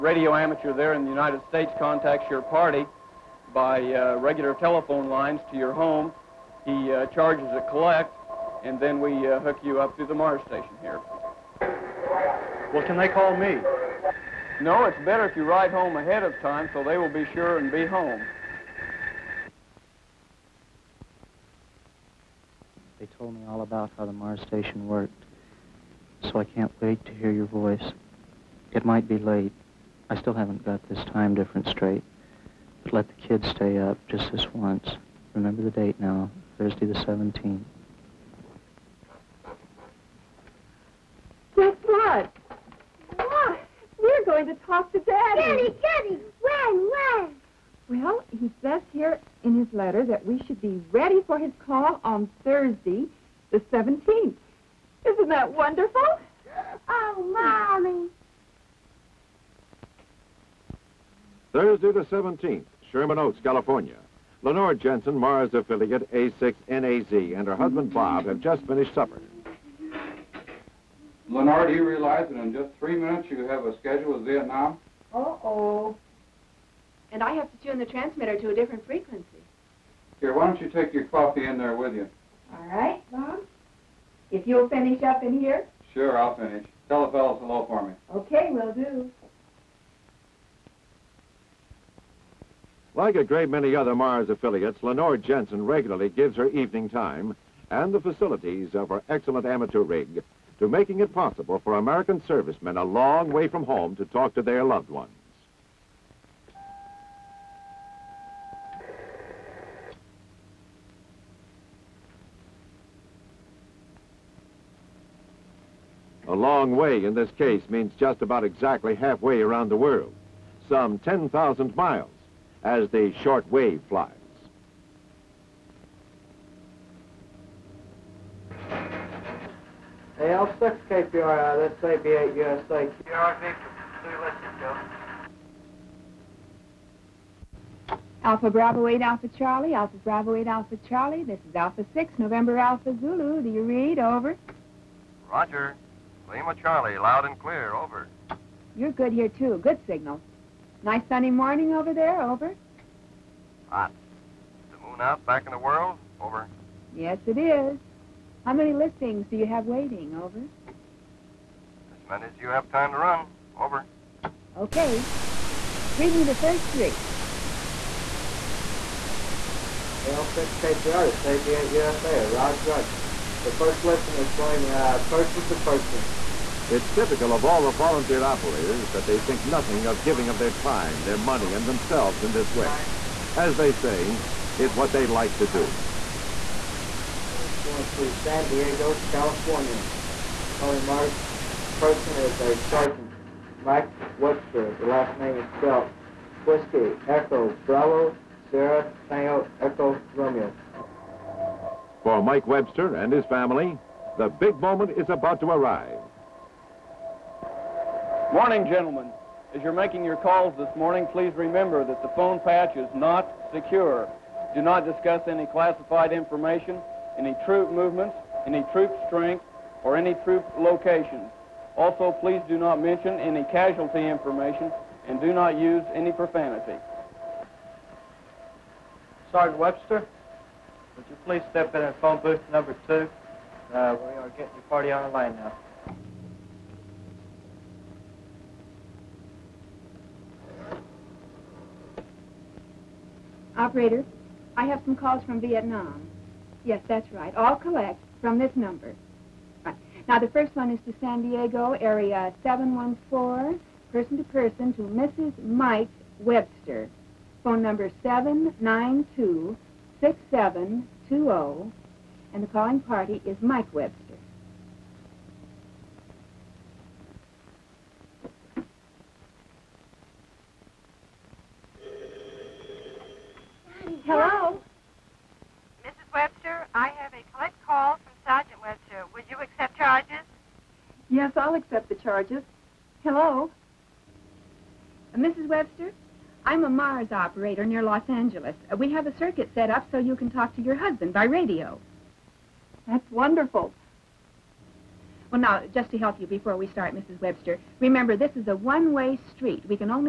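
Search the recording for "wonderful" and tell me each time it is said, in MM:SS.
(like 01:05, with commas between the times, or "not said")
00:55, 04:53.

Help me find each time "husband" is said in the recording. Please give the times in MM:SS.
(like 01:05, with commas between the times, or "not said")
01:07, 04:50.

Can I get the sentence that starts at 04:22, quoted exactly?
And the calling party is Mike Webster.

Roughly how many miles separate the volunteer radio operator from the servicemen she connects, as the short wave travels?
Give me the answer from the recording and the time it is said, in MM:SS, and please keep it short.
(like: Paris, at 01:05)
10,000, at 02:00.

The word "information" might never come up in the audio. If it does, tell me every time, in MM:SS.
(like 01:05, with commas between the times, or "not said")
03:36, 03:44.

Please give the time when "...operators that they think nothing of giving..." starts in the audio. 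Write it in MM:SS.
02:58.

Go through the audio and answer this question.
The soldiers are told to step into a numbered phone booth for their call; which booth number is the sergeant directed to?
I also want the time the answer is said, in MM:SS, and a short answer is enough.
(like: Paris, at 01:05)
2, at 03:52.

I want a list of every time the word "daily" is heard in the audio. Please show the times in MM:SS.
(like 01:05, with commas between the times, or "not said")
not said.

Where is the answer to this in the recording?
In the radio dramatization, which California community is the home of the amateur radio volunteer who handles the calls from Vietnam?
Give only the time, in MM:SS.
01:02.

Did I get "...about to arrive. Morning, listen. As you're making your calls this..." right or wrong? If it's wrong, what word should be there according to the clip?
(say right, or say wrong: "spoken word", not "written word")
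wrong: "gentlemen", not "listen".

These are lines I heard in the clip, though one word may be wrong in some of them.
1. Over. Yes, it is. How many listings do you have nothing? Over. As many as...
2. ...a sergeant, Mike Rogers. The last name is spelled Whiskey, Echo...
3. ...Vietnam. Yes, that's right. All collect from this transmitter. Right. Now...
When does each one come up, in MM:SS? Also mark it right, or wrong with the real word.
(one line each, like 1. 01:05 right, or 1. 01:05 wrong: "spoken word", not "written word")
1. 02:36 wrong: "waiting", not "nothing"
2. 03:12 wrong: "Webster", not "Rogers"
3. 04:05 wrong: "number", not "transmitter".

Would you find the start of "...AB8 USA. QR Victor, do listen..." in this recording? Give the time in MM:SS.
02:12.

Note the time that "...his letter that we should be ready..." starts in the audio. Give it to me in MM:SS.
00:49.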